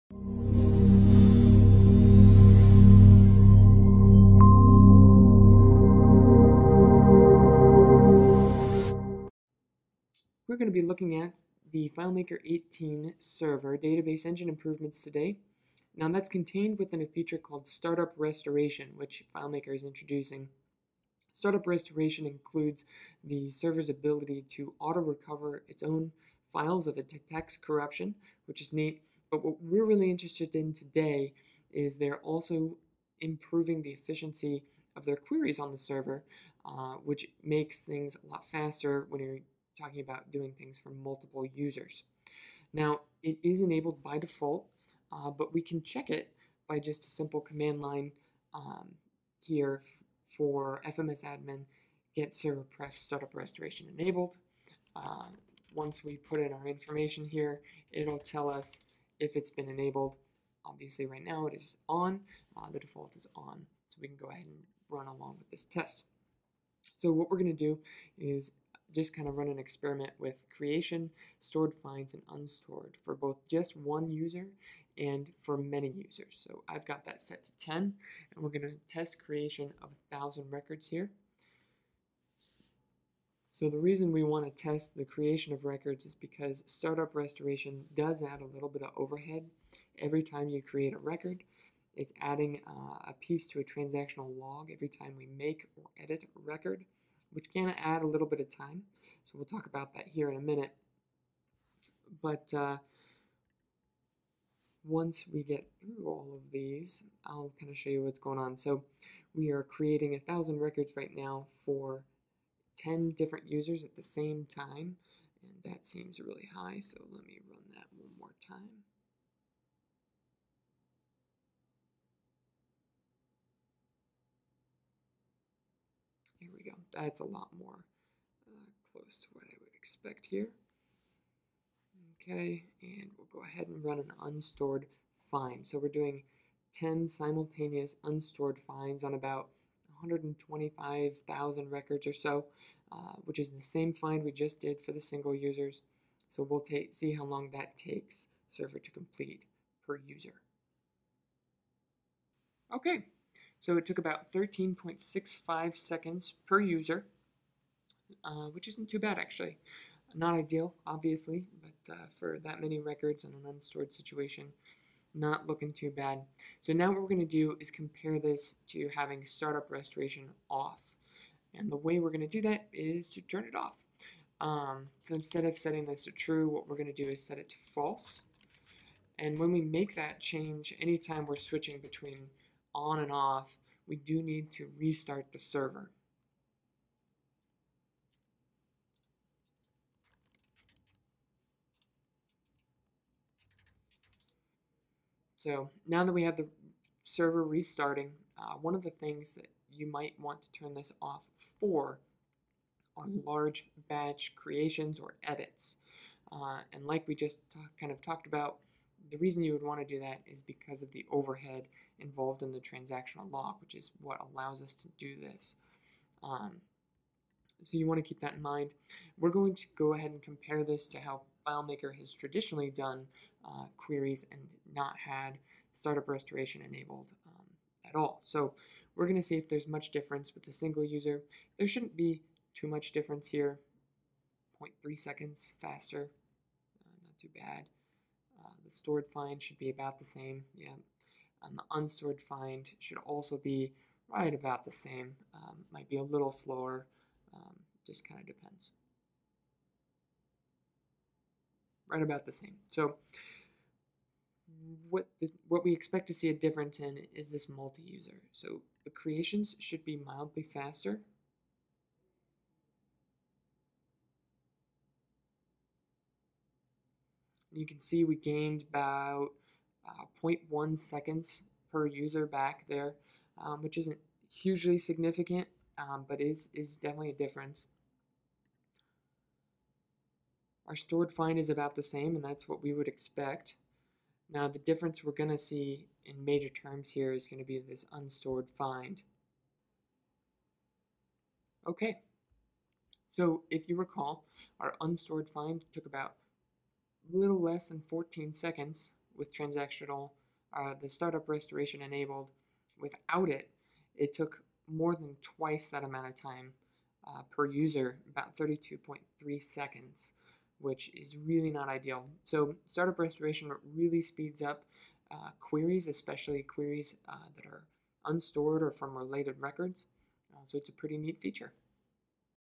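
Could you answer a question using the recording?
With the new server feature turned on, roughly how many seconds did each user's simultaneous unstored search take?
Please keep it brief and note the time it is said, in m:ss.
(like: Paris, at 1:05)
13.65 seconds, at 2:34.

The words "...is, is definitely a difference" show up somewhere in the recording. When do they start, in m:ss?
4:36.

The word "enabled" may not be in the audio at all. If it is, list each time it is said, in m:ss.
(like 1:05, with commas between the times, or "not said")
0:43, 0:53, 0:59, 3:46, 5:01.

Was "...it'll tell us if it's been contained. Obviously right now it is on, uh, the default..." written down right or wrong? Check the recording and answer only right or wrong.
wrong.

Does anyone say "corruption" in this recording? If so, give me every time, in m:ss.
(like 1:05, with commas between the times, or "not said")
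0:27.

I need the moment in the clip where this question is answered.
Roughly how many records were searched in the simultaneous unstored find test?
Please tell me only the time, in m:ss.
2:20.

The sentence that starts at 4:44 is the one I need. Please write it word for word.
Now the difference we're going to see in major terms here is going to be this unstored find.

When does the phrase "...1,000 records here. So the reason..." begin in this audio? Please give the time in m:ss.
1:20.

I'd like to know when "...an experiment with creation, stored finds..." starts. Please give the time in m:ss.
1:09.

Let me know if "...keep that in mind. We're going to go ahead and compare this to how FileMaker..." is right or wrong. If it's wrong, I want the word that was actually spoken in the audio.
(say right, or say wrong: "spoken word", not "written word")
right.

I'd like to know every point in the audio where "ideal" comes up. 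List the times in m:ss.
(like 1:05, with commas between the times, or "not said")
2:40, 5:11.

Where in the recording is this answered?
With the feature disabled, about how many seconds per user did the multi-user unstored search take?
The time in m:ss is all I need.
5:08.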